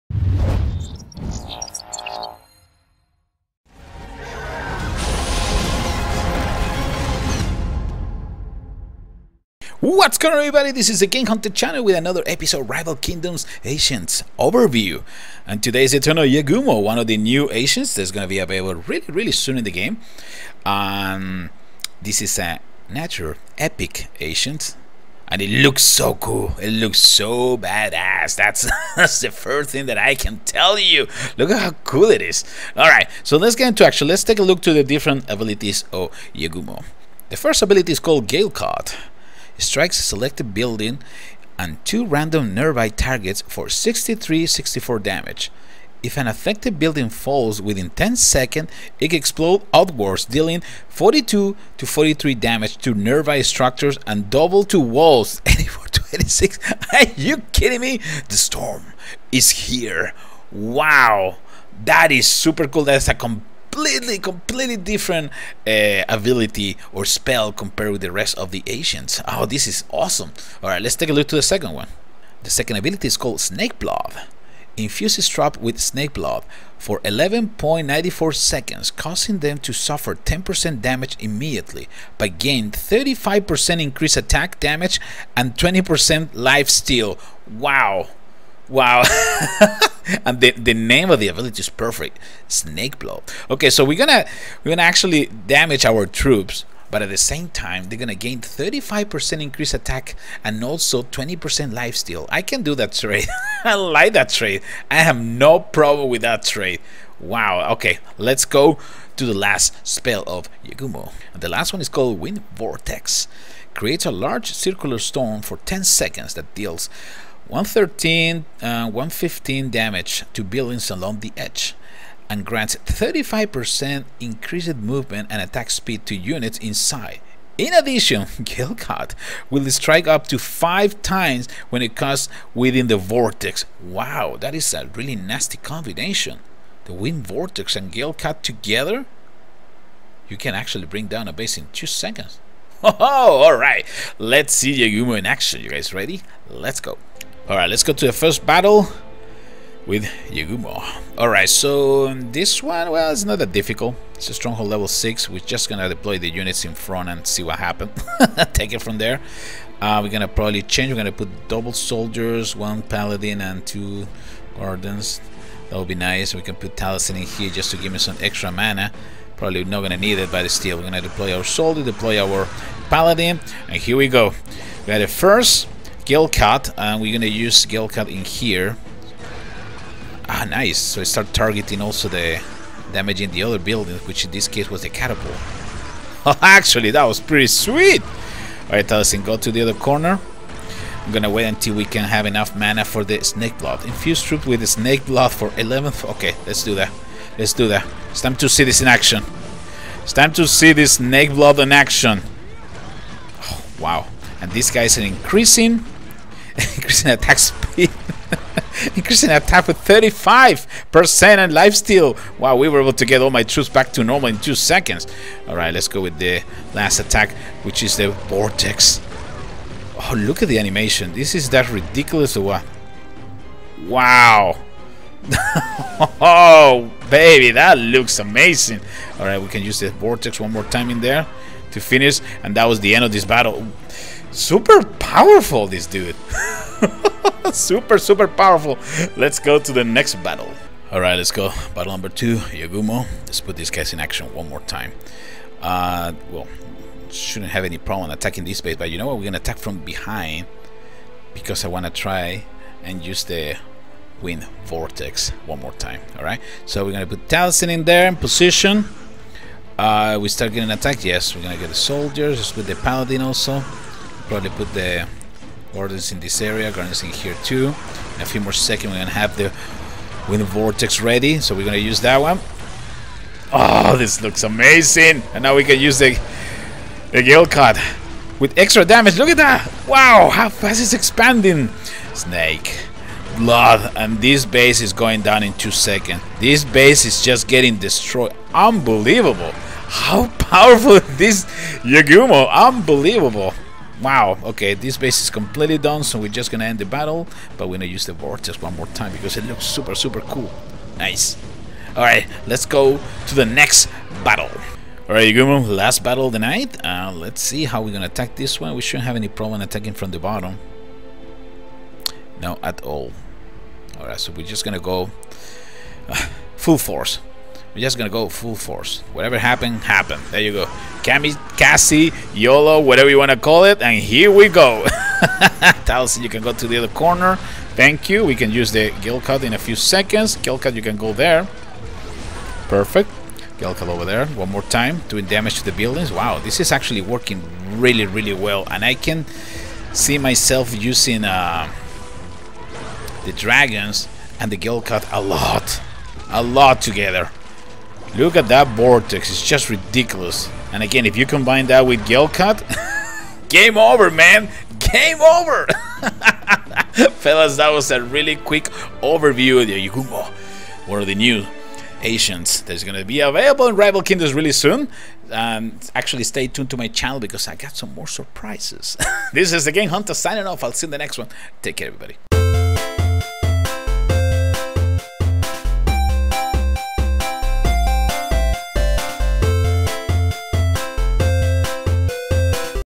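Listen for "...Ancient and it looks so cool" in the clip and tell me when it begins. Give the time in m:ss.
0:24.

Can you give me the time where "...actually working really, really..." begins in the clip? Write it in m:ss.
5:36.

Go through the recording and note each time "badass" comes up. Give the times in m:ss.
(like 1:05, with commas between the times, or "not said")
0:27.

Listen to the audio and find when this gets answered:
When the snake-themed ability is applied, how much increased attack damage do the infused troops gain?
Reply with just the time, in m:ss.
1:22.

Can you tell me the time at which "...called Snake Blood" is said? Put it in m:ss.
1:13.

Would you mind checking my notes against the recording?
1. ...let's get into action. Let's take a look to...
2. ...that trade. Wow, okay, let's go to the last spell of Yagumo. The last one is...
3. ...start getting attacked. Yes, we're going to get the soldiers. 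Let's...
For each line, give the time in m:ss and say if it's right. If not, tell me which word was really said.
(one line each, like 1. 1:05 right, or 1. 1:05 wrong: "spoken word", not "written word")
1. 0:33 right
2. 1:46 right
3. 4:20 right.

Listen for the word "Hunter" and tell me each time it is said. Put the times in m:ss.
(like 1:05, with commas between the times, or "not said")
0:11, 6:09.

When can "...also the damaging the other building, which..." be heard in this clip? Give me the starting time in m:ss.
3:01.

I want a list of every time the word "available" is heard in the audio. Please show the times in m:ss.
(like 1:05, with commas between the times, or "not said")
0:18, 6:03.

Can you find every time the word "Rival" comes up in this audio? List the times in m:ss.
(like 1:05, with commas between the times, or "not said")
0:12, 6:03.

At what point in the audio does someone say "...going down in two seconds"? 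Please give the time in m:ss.
4:44.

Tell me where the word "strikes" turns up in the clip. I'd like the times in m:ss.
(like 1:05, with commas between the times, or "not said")
0:39, 2:09.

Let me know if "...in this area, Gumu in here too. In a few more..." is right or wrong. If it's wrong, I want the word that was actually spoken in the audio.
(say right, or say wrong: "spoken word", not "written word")
wrong: "Guardians", not "Gumu".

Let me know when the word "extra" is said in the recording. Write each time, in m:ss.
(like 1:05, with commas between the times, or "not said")
2:48, 4:38.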